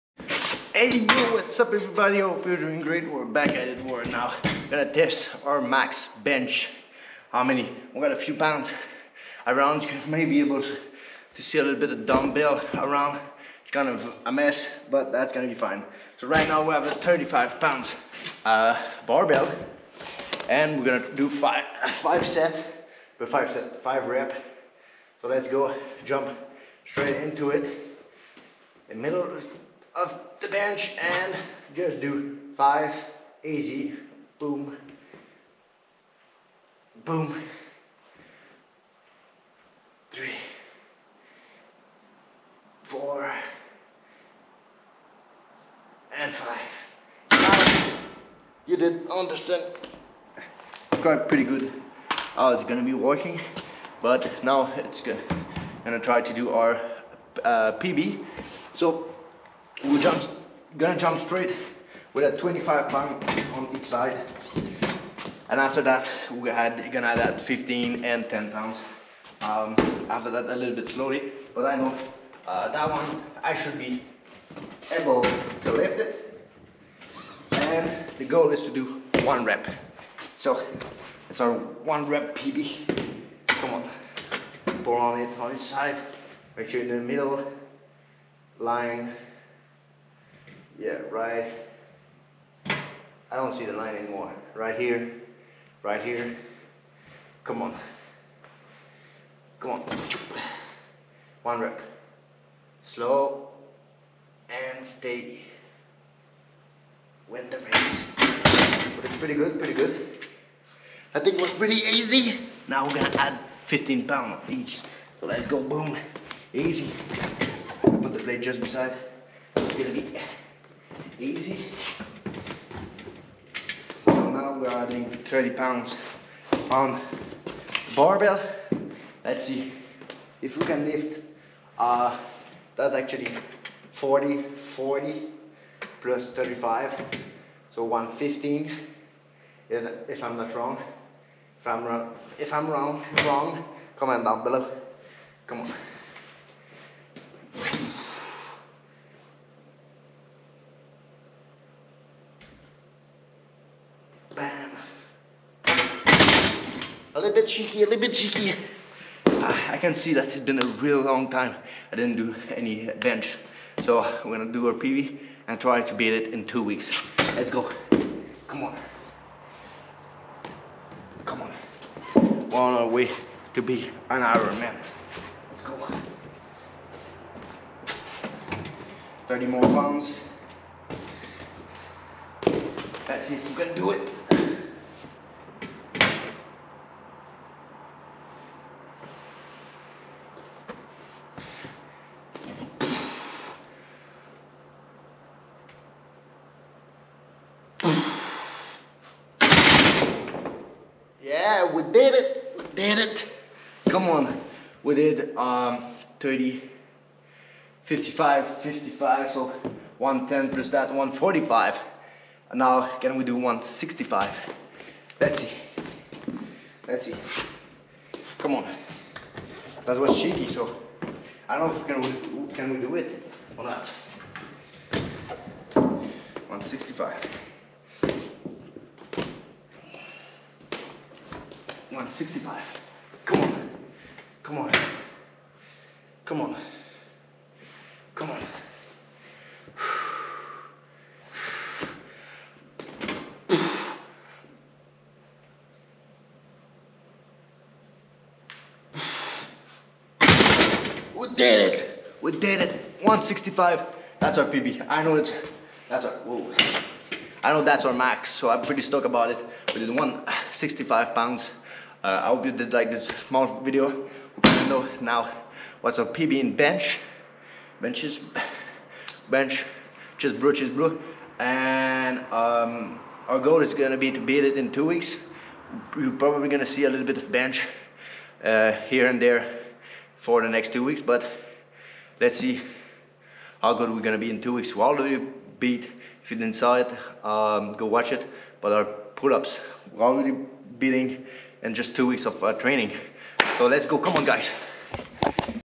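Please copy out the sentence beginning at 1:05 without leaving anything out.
And after that, we're gonna add that 15 and 10 pounds.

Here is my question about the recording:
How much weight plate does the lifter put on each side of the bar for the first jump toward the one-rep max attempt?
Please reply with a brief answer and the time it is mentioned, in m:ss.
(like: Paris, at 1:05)
25 pounds, at 1:02.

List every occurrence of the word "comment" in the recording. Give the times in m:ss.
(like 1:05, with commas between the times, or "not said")
2:23.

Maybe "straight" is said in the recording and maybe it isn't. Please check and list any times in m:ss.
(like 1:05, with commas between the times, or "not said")
0:26, 1:01.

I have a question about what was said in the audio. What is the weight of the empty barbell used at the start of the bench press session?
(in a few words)
35 pounds.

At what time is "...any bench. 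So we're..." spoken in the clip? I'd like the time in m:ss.
2:42.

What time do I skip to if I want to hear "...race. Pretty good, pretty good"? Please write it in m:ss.
1:47.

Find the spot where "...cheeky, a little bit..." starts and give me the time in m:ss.
2:37.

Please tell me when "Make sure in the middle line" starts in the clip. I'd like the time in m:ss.
1:26.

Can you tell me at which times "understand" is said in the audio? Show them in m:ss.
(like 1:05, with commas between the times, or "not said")
0:49.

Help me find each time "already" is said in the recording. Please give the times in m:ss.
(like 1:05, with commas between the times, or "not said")
4:44, 4:50.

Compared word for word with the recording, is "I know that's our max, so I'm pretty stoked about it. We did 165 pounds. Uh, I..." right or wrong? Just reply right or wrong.
right.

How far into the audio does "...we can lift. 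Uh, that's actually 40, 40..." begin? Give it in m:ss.
2:10.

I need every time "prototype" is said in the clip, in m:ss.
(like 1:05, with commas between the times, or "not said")
not said.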